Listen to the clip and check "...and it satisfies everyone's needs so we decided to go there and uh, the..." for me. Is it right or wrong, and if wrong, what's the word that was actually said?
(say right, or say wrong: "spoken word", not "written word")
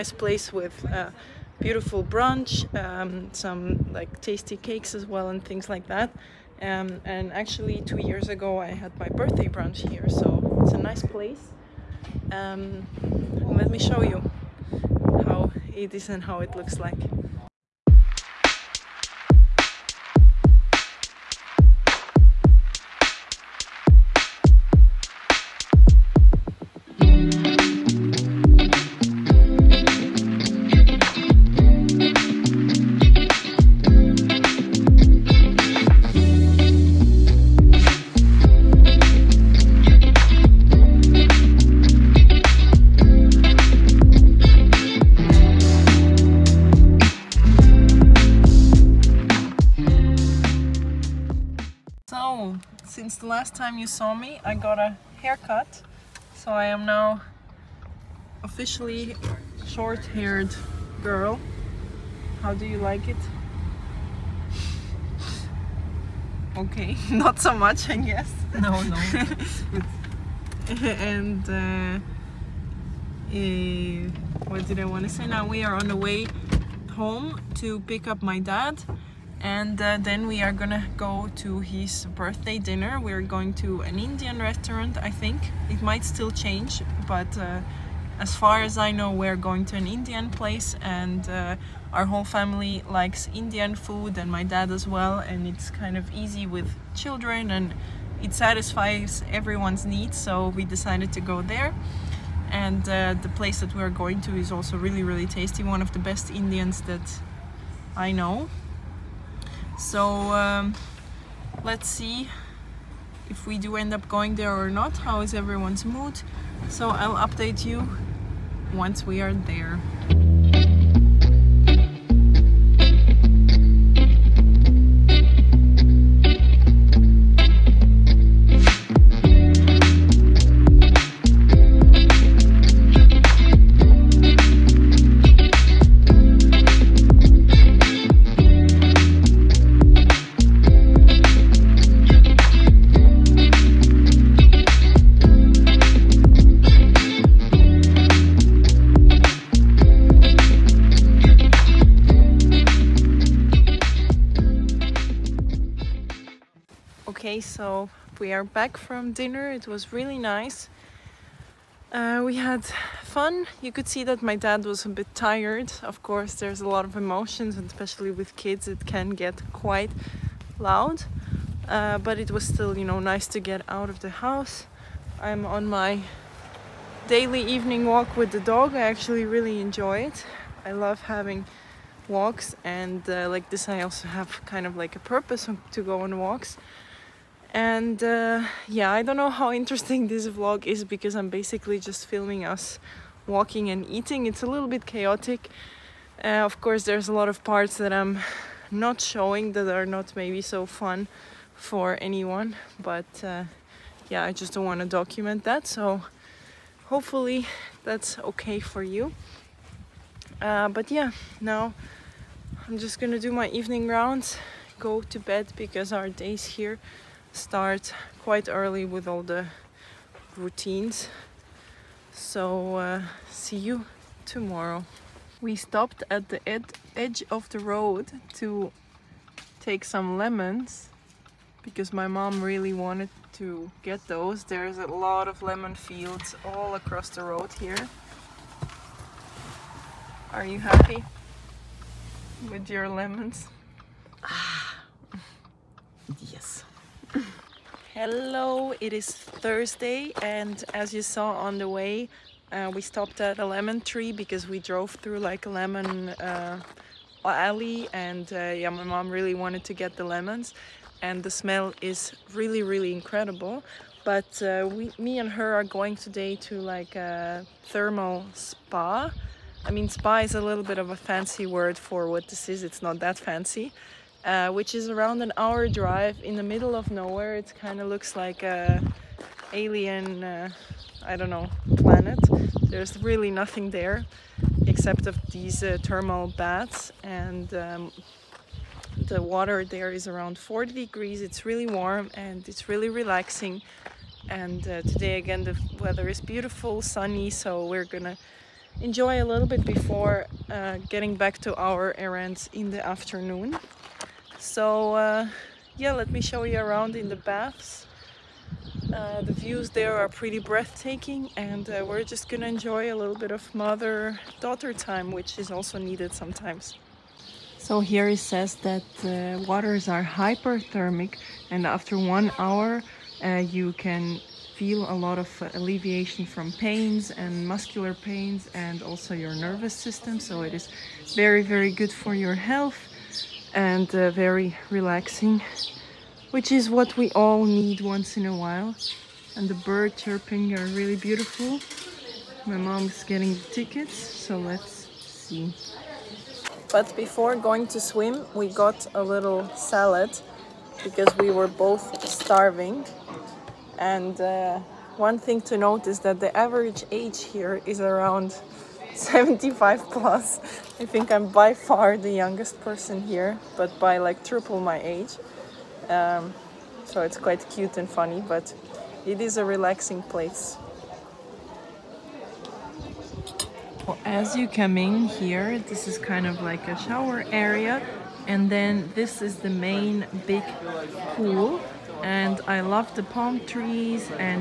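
right.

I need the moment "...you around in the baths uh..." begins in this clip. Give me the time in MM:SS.
05:06.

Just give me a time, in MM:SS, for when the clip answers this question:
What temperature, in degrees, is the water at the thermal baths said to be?
04:50.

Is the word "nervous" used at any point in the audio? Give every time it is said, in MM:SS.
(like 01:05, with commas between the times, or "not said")
05:29.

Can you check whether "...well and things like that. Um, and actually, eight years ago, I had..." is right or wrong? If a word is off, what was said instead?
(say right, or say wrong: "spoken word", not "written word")
wrong: "two", not "eight".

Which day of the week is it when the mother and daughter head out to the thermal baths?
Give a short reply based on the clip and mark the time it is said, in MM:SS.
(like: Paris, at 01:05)
Thursday, at 04:09.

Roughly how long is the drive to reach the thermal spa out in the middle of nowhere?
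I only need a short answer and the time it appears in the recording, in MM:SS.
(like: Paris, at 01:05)
Around 1 hour, at 04:34.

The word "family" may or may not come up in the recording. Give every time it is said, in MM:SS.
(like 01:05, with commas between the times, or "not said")
01:32.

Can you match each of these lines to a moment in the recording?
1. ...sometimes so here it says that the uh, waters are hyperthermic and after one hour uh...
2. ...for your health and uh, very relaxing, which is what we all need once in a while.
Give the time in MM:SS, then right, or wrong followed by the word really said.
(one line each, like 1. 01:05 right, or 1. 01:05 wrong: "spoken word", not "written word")
1. 05:16 right
2. 05:31 right.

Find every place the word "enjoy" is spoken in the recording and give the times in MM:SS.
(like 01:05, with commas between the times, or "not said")
02:59, 04:58, 05:12.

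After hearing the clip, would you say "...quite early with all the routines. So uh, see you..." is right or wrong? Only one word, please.
right.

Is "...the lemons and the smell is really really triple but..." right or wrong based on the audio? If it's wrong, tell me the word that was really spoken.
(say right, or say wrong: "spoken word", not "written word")
wrong: "incredible", not "triple".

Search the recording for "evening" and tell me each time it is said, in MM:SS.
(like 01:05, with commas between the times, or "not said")
02:57, 03:33.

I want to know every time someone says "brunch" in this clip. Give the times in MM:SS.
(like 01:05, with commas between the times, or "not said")
00:02, 00:09.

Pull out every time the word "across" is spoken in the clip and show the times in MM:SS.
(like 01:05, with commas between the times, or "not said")
03:56.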